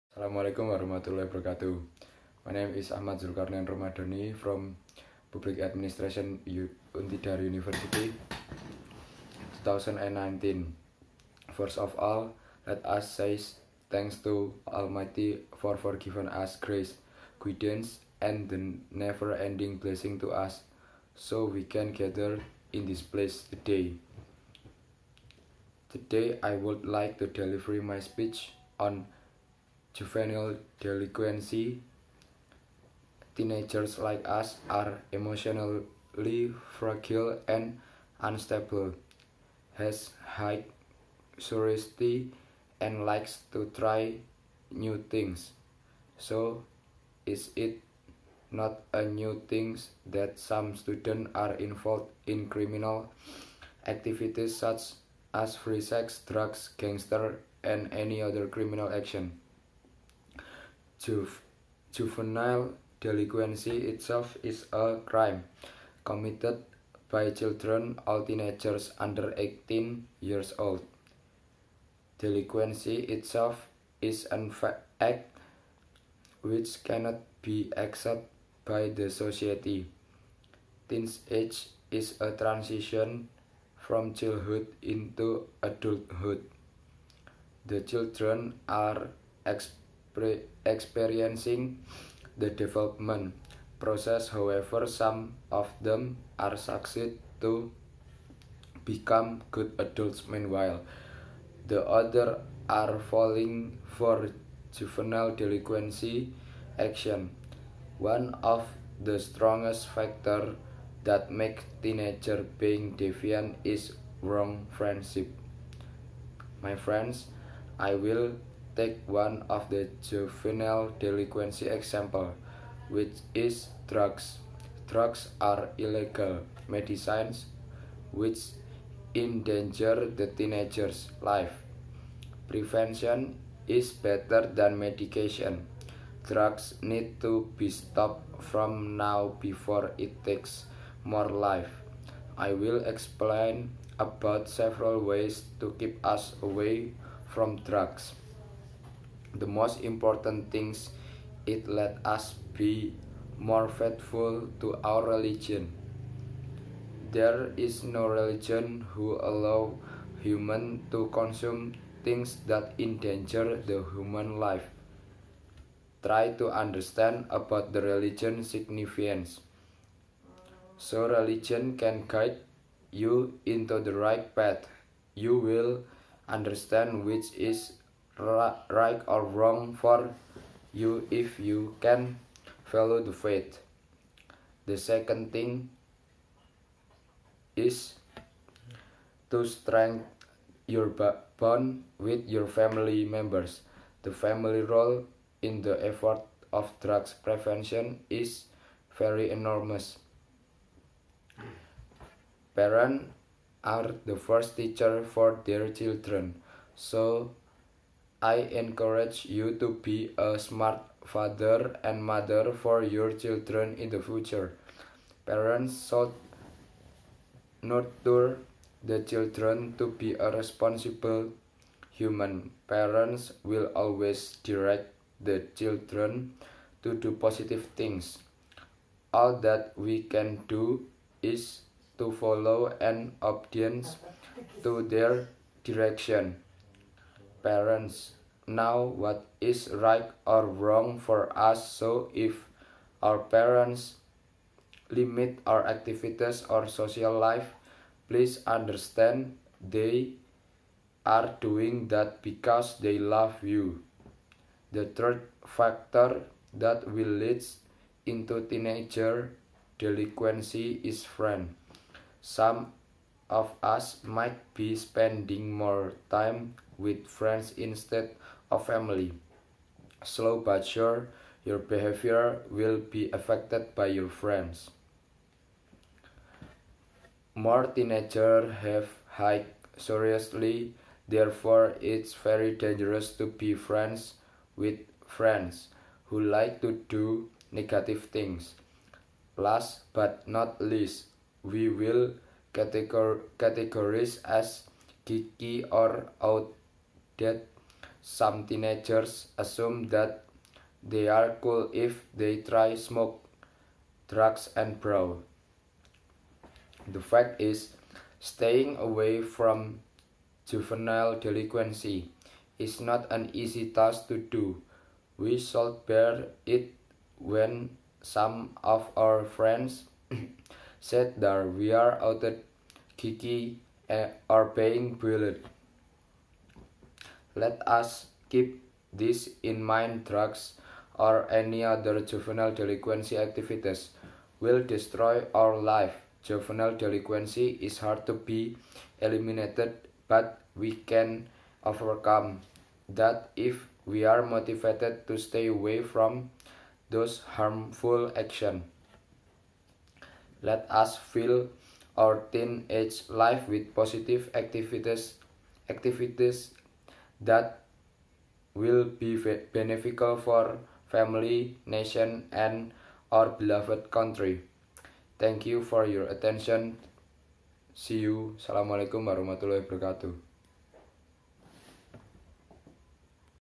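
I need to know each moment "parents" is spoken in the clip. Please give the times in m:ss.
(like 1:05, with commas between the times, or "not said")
3:22, 3:35, 3:42, 3:57, 4:03.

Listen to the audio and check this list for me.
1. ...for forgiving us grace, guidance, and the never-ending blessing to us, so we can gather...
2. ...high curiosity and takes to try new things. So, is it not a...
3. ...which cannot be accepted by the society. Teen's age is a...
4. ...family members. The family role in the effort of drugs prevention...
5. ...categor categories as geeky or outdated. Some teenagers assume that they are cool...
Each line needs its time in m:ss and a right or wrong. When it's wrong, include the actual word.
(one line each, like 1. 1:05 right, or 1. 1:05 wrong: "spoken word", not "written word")
1. 0:15 right
2. 0:40 wrong: "likes", not "takes"
3. 1:16 right
4. 3:12 right
5. 4:52 right.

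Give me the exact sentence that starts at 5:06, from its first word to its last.
The fact is, staying away from juvenile delinquency is not an easy task to do.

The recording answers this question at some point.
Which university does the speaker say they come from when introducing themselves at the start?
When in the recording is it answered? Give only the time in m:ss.
0:06.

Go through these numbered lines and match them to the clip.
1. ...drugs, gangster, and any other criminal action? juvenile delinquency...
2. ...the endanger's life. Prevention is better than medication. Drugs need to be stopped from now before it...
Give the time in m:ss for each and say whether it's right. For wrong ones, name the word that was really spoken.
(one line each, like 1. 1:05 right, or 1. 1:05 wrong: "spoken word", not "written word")
1. 0:56 right
2. 2:10 wrong: "teenager", not "endanger".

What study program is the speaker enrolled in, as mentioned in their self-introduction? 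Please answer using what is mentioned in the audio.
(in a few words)
Public Administration.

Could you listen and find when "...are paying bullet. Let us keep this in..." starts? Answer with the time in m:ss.
5:24.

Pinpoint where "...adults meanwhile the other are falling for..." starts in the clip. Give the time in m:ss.
1:39.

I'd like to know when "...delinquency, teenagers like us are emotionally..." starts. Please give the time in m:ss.
0:30.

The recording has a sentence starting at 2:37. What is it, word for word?
There is no religion who allow human to consume things that endanger the human life.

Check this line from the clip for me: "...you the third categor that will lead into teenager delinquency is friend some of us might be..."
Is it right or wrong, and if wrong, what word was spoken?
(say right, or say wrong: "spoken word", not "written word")
wrong: "factor", not "categor".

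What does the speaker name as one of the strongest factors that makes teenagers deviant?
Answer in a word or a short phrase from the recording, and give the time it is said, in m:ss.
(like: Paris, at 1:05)
Wrong friendship, at 1:54.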